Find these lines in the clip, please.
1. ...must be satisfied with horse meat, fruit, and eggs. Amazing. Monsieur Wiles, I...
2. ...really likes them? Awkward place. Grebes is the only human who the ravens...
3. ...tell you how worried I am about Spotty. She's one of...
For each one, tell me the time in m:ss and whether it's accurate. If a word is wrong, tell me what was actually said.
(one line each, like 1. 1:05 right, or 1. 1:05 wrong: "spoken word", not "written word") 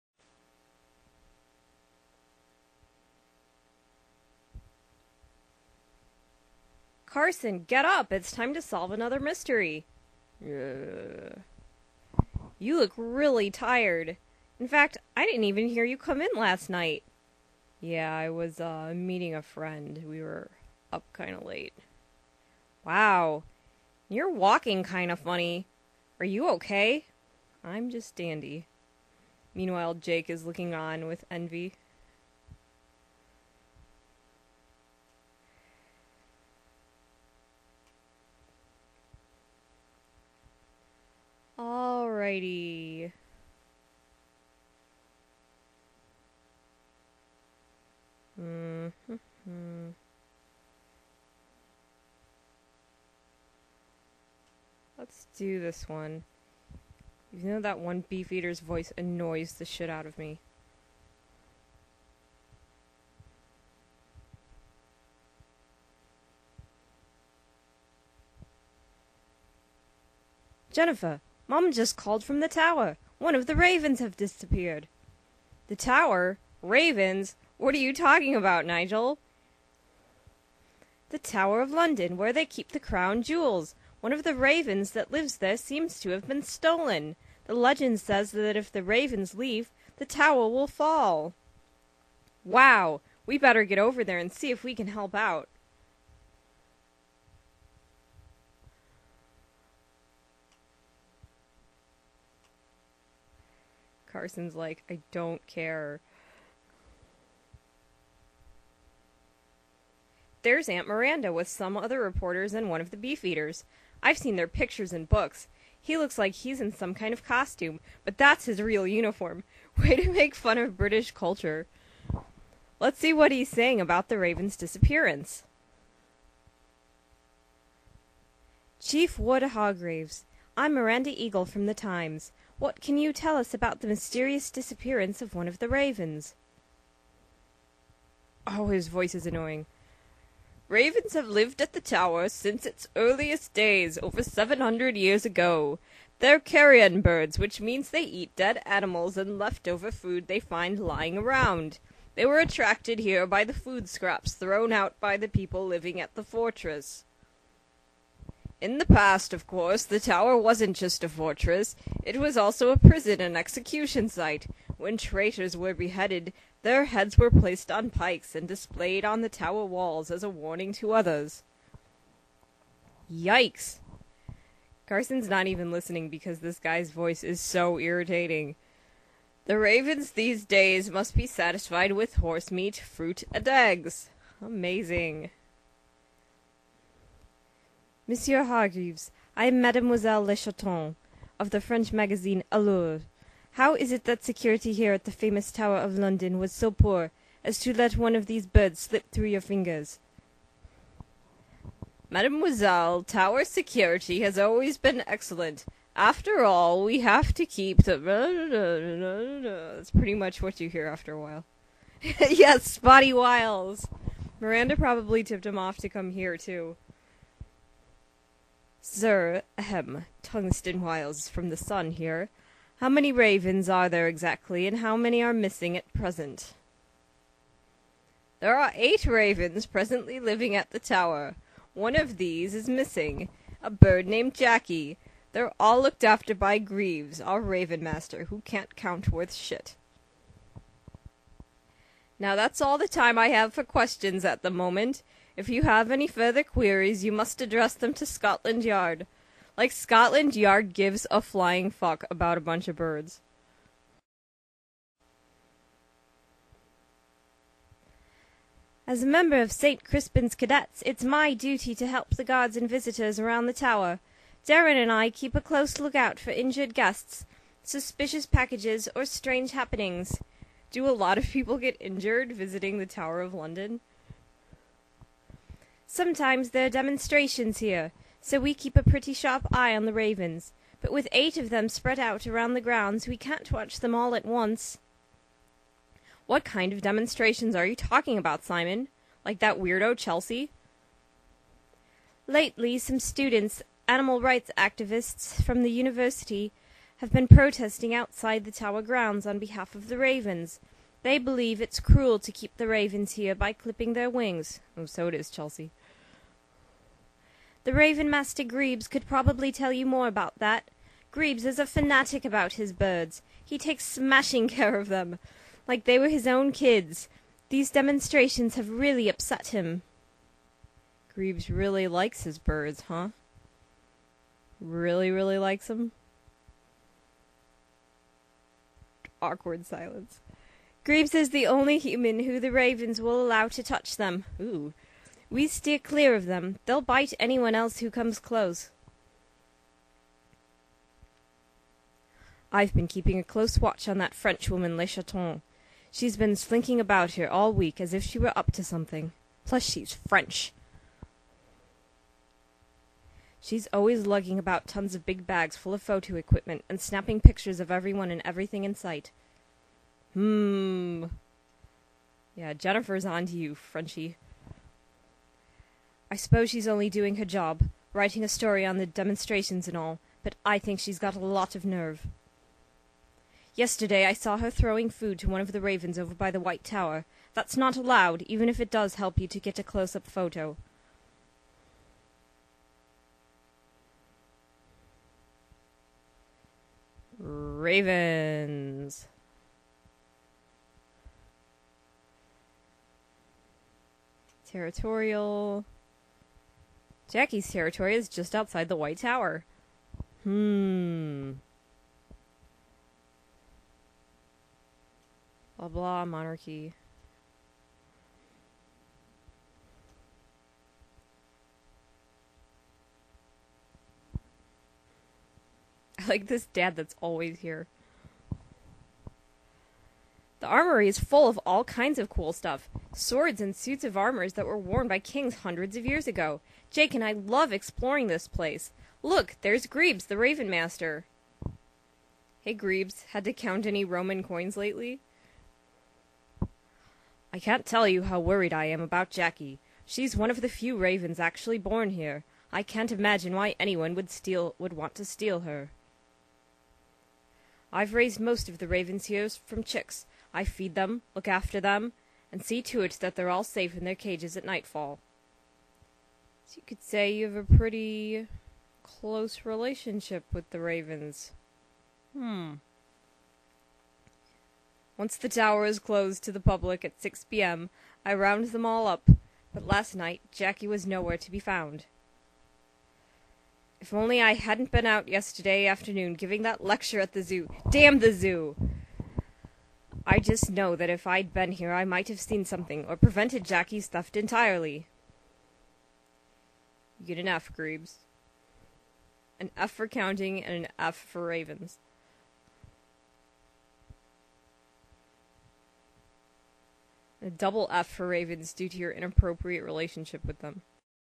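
1. 3:00 wrong: "Hargreaves", not "Wiles"
2. 5:25 wrong: "silence", not "place"
3. 7:17 wrong: "Jackie", not "Spotty".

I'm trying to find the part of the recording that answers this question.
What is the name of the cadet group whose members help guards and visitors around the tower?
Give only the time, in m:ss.
4:19.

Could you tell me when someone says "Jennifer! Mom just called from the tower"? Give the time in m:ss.
1:10.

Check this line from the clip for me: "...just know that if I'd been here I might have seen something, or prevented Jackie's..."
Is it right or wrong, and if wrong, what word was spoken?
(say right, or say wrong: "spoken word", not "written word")
right.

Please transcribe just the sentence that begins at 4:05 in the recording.
If you have any further queries, you must address them to Scotland Yard.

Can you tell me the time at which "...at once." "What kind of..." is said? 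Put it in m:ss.
4:44.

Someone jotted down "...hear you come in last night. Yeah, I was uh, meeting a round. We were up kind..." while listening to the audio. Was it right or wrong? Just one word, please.
wrong.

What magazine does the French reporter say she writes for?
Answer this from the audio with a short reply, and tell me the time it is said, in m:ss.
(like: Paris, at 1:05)
Allure, at 3:12.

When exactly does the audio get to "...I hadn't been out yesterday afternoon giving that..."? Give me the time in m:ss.
7:54.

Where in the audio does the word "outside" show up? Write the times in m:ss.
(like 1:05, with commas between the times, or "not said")
4:57, 6:38.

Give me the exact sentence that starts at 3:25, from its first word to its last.
After all, we have to keep the That's pretty much what you hear after a while.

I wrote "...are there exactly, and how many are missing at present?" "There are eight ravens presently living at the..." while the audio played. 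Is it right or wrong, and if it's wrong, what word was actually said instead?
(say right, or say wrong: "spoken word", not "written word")
right.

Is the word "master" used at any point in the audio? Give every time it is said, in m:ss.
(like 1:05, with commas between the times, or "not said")
3:57, 5:08, 7:10.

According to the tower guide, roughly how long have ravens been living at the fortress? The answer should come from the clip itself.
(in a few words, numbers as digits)
over 700 years.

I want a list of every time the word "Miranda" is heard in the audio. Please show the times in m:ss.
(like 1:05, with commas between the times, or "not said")
1:50, 2:10, 3:34.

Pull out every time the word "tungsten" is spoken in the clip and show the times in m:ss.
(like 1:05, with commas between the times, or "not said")
3:40.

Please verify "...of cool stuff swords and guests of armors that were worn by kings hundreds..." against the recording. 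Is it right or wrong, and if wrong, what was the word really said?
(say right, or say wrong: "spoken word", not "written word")
wrong: "suits", not "guests".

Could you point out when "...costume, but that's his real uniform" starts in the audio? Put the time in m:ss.
1:57.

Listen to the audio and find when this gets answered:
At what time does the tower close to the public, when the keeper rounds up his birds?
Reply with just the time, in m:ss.
7:47.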